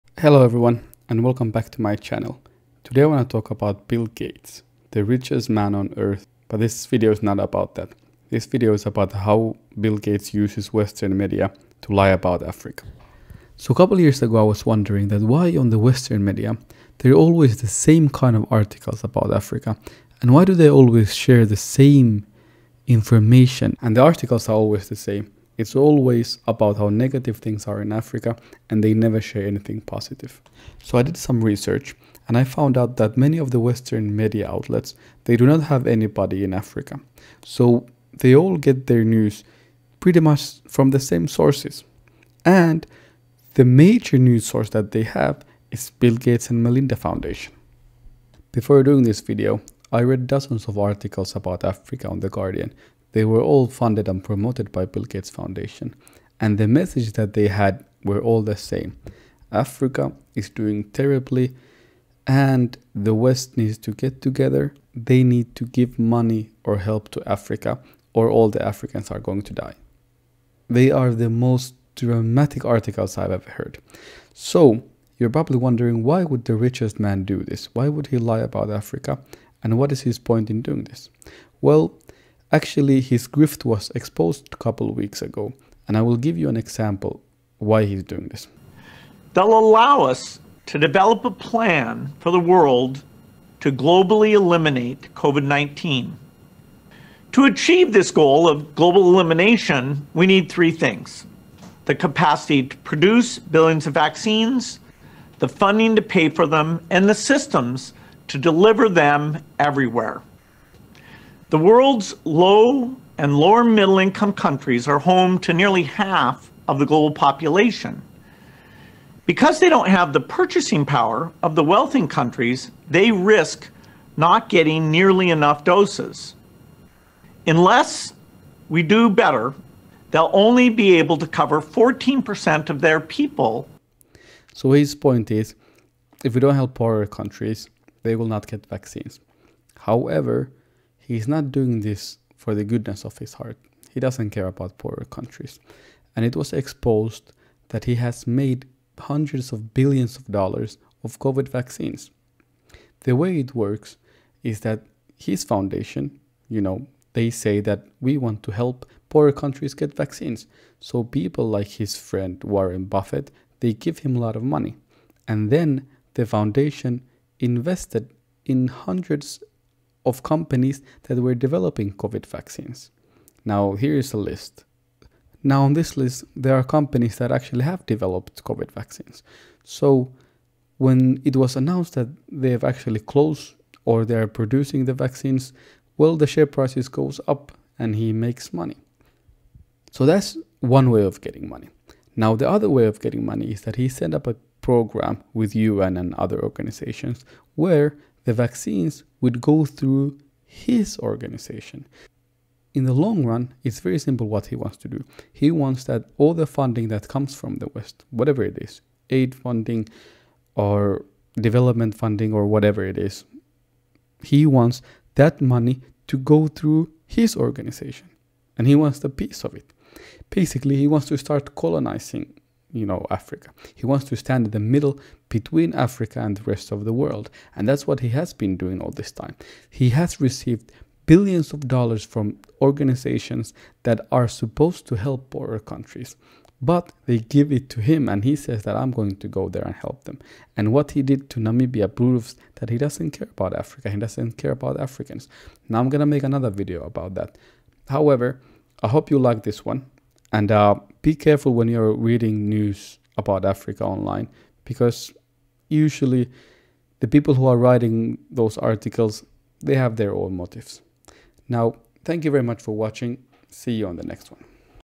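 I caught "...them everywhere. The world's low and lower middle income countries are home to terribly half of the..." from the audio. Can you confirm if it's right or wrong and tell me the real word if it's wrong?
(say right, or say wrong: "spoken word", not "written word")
wrong: "nearly", not "terribly".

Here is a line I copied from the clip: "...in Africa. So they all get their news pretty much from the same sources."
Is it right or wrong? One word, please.
right.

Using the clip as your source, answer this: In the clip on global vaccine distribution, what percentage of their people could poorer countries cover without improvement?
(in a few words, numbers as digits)
14%.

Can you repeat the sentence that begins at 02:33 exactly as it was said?
The way it works is that his foundation, you know, they say that we want to help poorer countries get vaccines.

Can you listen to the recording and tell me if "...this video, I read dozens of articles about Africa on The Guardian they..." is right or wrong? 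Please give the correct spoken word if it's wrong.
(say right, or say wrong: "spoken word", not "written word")
right.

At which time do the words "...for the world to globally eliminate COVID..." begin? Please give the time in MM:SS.
01:32.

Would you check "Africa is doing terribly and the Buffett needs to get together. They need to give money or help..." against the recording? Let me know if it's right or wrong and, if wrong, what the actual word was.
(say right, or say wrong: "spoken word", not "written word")
wrong: "West", not "Buffett".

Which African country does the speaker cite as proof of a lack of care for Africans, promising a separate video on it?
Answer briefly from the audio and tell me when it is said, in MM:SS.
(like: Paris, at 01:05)
Namibia, at 04:01.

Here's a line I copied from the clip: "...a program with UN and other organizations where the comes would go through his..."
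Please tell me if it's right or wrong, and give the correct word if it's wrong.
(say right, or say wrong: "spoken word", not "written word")
wrong: "vaccines", not "comes".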